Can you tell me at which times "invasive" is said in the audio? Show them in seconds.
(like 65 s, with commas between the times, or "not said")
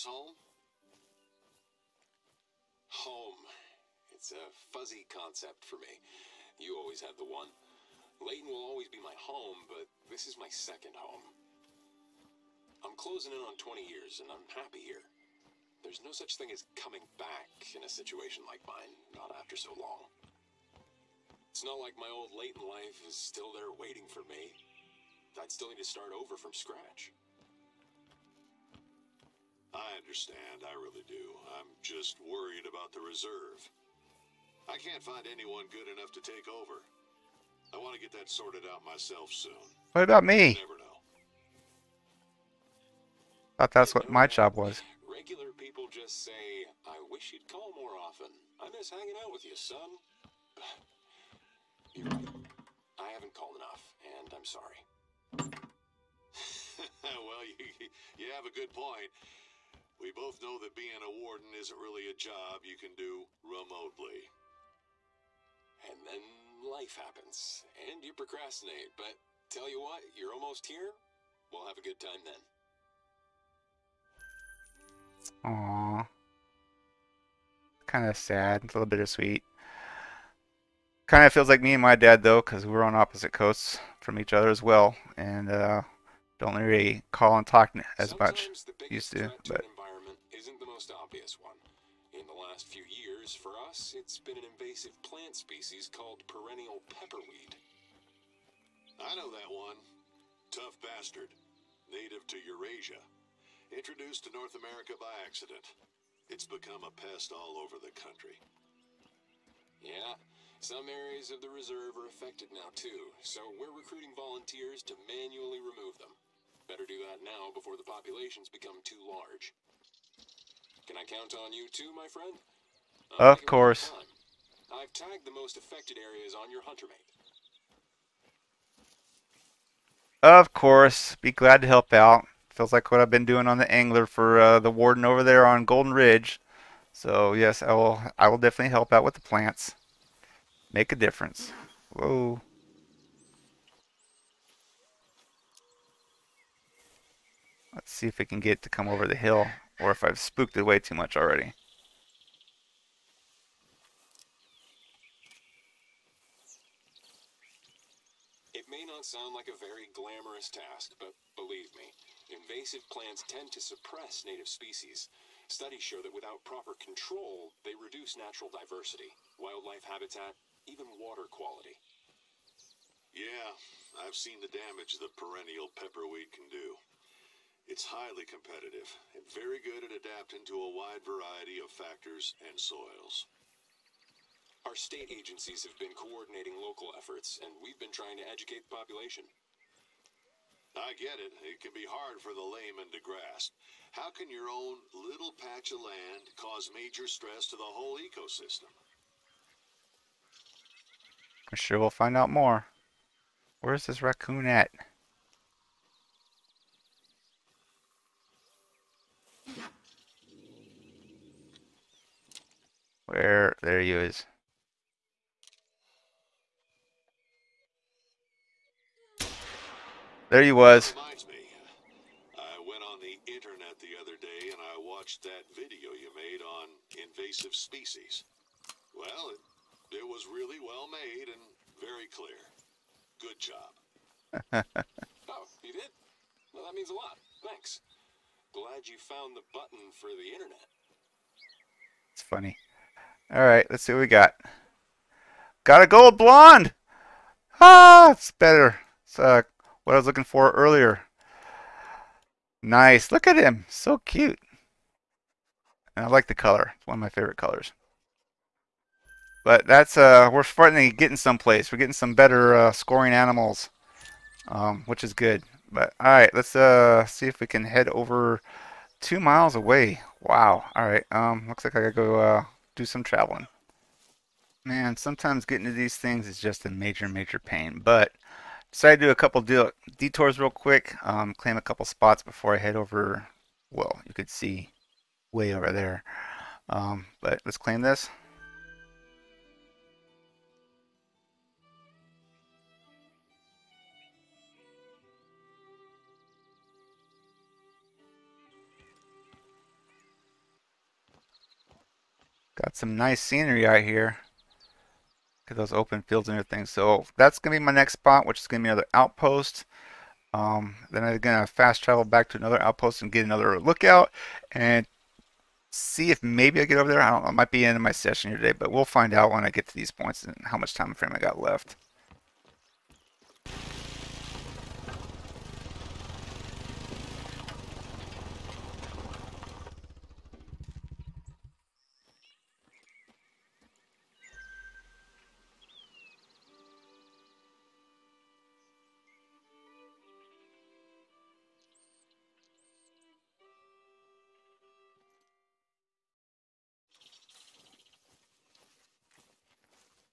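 94 s, 162 s, 227 s.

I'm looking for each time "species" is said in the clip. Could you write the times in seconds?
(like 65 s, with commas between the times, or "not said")
95 s, 164 s, 227 s.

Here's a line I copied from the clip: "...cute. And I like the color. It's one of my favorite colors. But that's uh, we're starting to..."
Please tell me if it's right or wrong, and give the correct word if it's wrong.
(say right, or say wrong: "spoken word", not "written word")
right.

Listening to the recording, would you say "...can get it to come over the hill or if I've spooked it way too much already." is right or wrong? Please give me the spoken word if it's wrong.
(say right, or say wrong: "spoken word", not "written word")
right.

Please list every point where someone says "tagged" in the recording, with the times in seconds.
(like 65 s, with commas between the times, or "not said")
124 s.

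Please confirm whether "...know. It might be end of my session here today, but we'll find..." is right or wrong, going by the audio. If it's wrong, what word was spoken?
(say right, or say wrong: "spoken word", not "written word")
right.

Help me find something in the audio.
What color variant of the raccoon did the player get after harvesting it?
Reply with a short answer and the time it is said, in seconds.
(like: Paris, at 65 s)
gold blonde, at 245 s.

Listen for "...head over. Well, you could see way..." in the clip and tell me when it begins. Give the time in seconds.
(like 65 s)
282 s.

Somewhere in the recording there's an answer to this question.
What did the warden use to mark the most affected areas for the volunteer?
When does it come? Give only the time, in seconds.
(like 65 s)
126 s.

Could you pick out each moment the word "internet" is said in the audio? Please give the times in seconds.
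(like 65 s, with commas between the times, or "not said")
223 s, 240 s.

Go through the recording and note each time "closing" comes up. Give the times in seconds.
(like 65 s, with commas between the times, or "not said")
13 s.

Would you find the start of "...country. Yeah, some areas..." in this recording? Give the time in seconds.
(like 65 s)
107 s.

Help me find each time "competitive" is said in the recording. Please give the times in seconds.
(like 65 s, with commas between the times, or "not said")
178 s.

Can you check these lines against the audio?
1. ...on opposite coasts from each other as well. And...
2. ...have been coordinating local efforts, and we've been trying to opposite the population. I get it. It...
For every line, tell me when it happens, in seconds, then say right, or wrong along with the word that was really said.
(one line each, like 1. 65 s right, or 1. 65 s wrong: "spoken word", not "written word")
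1. 82 s right
2. 185 s wrong: "educate", not "opposite".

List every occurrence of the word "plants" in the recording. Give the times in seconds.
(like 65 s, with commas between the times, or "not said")
95 s, 139 s, 162 s.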